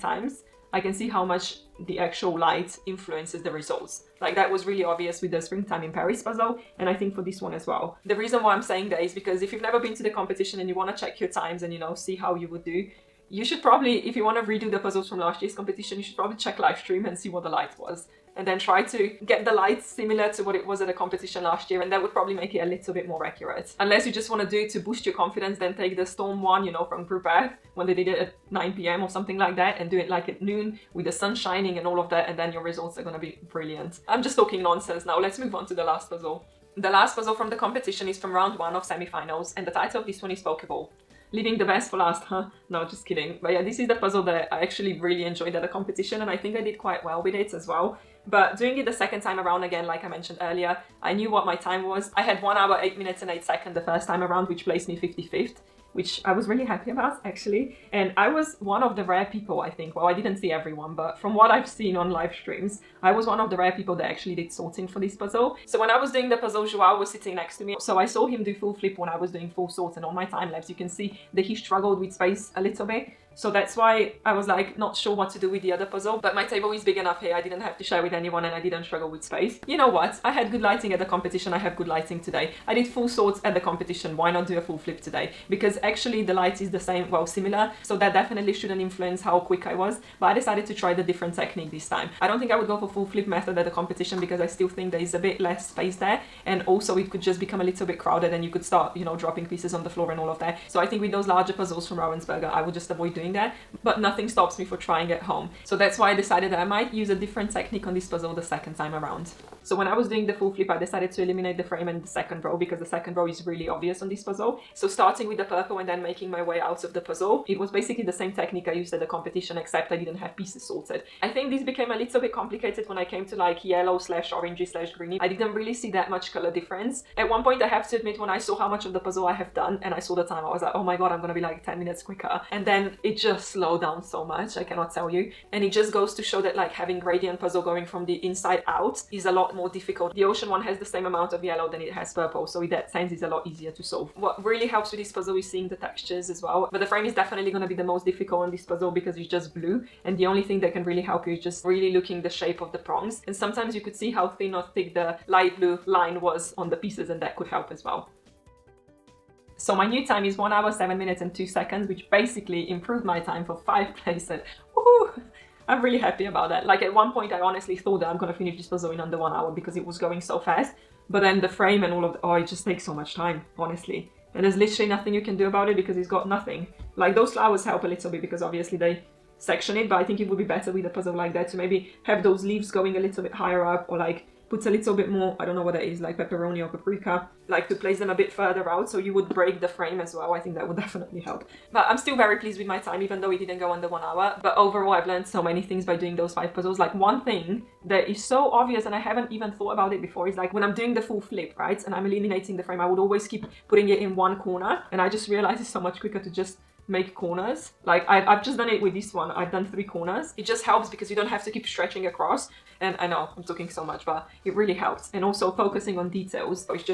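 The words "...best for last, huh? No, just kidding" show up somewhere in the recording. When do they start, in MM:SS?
00:41.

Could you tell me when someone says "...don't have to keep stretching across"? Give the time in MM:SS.
03:31.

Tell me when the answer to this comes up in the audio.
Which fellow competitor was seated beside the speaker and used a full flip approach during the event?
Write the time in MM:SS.
01:06.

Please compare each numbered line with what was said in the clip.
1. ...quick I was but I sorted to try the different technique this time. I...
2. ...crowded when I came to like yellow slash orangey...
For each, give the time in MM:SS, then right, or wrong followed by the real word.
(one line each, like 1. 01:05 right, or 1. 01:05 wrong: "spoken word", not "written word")
1. 01:29 wrong: "decided", not "sorted"
2. 02:02 wrong: "complicated", not "crowded".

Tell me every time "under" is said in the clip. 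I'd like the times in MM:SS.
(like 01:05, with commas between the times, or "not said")
02:48, 03:13.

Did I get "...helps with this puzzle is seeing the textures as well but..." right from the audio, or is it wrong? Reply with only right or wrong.
right.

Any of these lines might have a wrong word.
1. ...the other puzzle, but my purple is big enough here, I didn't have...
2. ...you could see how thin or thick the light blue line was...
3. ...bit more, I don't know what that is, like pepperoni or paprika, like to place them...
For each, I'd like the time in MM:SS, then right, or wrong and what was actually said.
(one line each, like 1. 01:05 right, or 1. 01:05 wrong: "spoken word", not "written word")
1. 01:15 wrong: "table", not "purple"
2. 02:33 right
3. 03:04 right.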